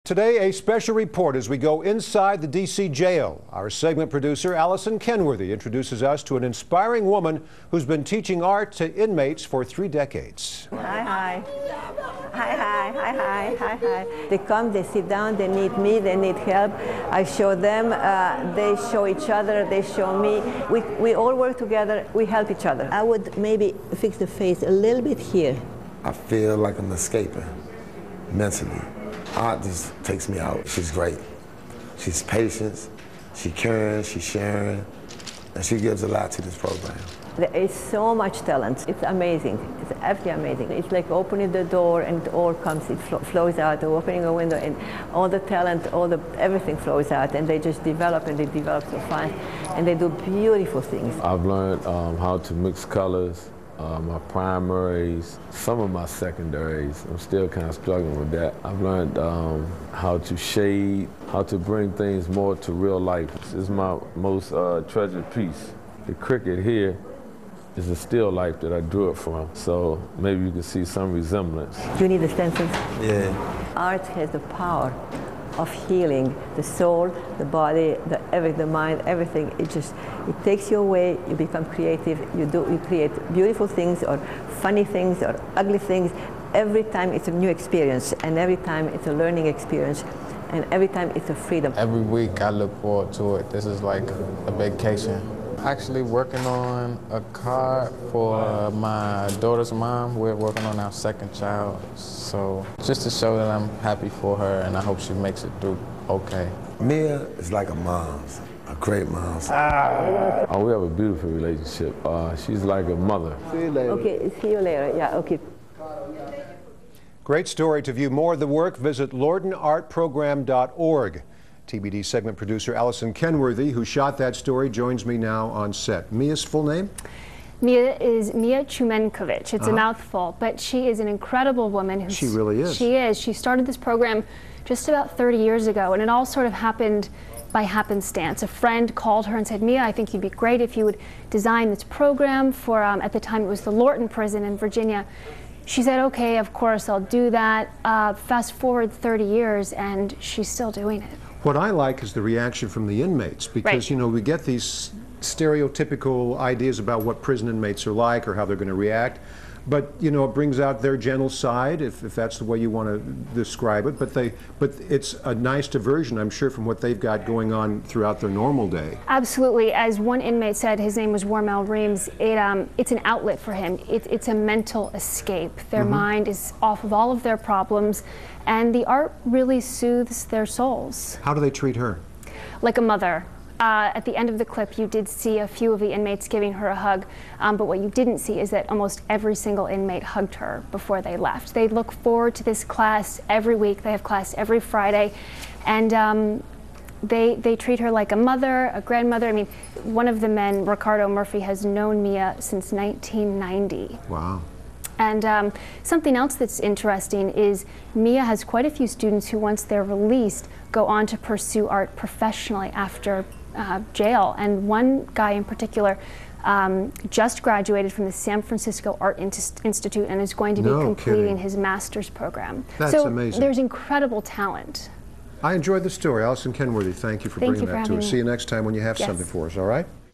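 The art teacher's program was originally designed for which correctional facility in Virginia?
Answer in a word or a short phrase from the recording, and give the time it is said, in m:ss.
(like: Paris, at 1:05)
Lorton prison, at 2:23.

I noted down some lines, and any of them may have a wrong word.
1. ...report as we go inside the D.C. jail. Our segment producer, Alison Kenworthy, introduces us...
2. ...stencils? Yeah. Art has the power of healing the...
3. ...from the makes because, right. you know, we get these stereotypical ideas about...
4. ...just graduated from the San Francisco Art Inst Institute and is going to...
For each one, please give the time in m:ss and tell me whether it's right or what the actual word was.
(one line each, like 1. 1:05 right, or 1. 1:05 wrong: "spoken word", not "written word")
1. 0:00 right
2. 1:12 right
3. 2:32 wrong: "inmates", not "makes"
4. 3:37 right.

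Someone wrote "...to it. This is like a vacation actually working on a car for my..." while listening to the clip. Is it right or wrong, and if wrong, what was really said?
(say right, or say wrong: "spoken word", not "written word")
right.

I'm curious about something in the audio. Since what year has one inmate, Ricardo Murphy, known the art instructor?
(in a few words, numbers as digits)
1990.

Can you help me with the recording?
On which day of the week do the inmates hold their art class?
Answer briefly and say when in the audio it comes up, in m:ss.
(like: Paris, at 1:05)
Friday, at 3:14.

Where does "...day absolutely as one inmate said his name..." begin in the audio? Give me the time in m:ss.
2:48.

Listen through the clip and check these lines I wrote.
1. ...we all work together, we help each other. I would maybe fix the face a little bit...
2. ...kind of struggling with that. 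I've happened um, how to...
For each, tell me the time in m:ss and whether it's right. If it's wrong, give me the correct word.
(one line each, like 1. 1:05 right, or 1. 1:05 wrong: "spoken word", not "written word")
1. 0:20 right
2. 0:57 wrong: "learned", not "happened".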